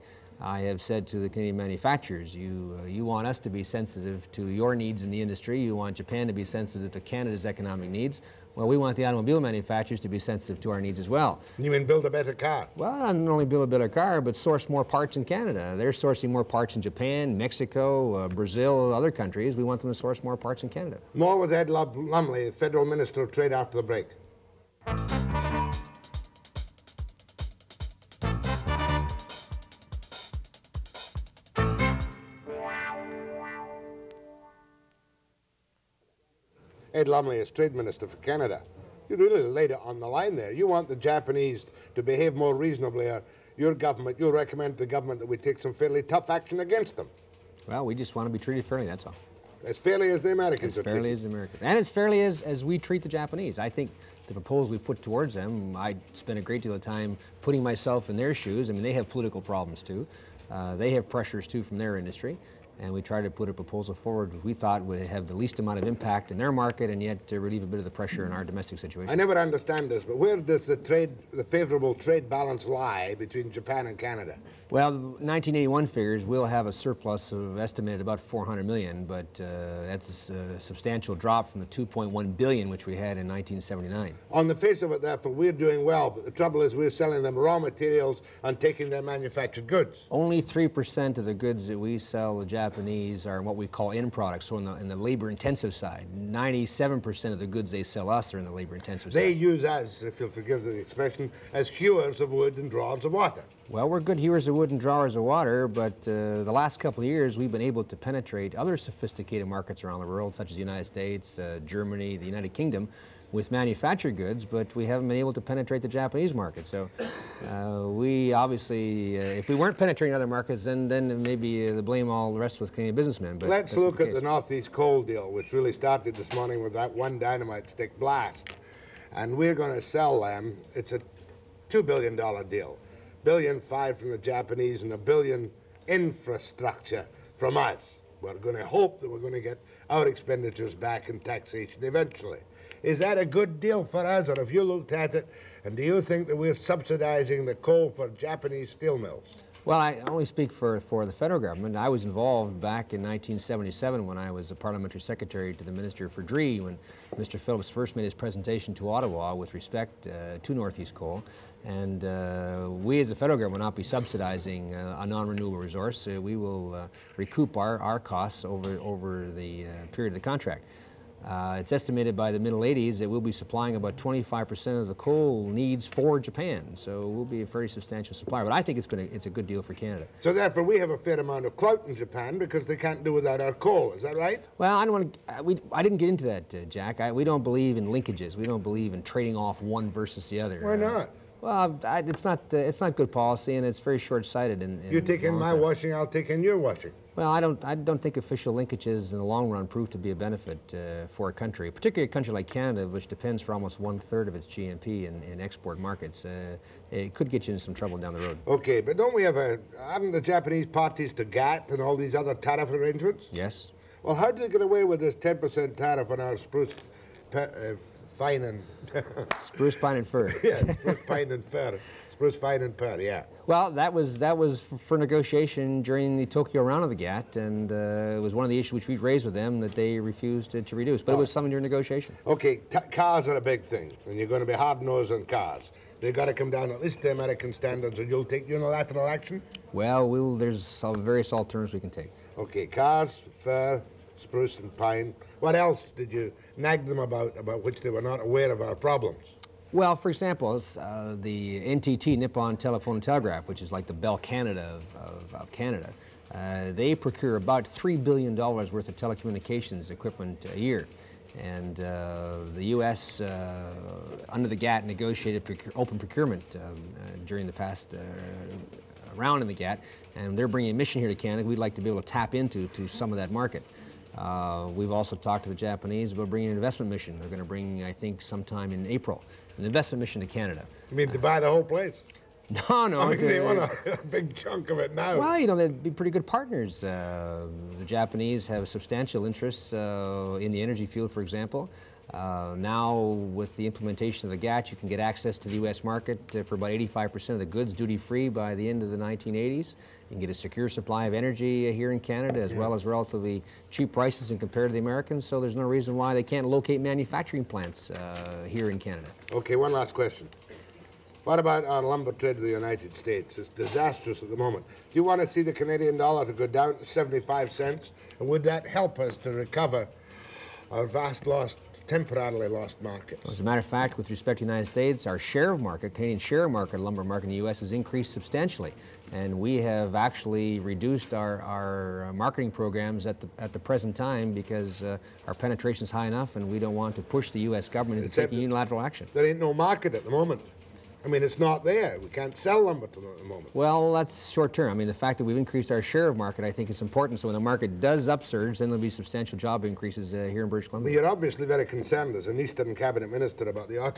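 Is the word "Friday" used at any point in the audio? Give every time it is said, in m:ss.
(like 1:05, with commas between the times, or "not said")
not said.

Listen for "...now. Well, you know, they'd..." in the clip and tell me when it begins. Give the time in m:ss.
4:44.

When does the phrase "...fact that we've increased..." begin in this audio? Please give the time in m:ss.
5:44.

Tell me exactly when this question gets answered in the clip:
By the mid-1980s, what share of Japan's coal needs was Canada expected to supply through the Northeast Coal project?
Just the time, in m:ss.
2:53.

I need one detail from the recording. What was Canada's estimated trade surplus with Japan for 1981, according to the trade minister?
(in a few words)
400 million.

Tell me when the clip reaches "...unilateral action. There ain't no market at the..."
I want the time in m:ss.
5:38.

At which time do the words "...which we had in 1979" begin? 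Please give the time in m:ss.
1:22.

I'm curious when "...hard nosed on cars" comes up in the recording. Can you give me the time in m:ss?
3:54.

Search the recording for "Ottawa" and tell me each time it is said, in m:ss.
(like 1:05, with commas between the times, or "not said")
2:38.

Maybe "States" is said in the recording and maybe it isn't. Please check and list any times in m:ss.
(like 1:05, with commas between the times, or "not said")
1:50, 5:12, 5:24.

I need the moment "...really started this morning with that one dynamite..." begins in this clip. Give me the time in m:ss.
2:05.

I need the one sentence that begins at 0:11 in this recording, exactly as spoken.
You mean build a better car?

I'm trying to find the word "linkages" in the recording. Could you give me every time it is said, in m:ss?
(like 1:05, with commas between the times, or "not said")
3:07, 3:18.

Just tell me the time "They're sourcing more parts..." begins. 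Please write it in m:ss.
0:15.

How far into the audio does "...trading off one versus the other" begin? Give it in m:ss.
3:09.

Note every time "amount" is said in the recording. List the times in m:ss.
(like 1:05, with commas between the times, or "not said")
1:05, 3:01.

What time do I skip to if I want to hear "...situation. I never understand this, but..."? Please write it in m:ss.
1:08.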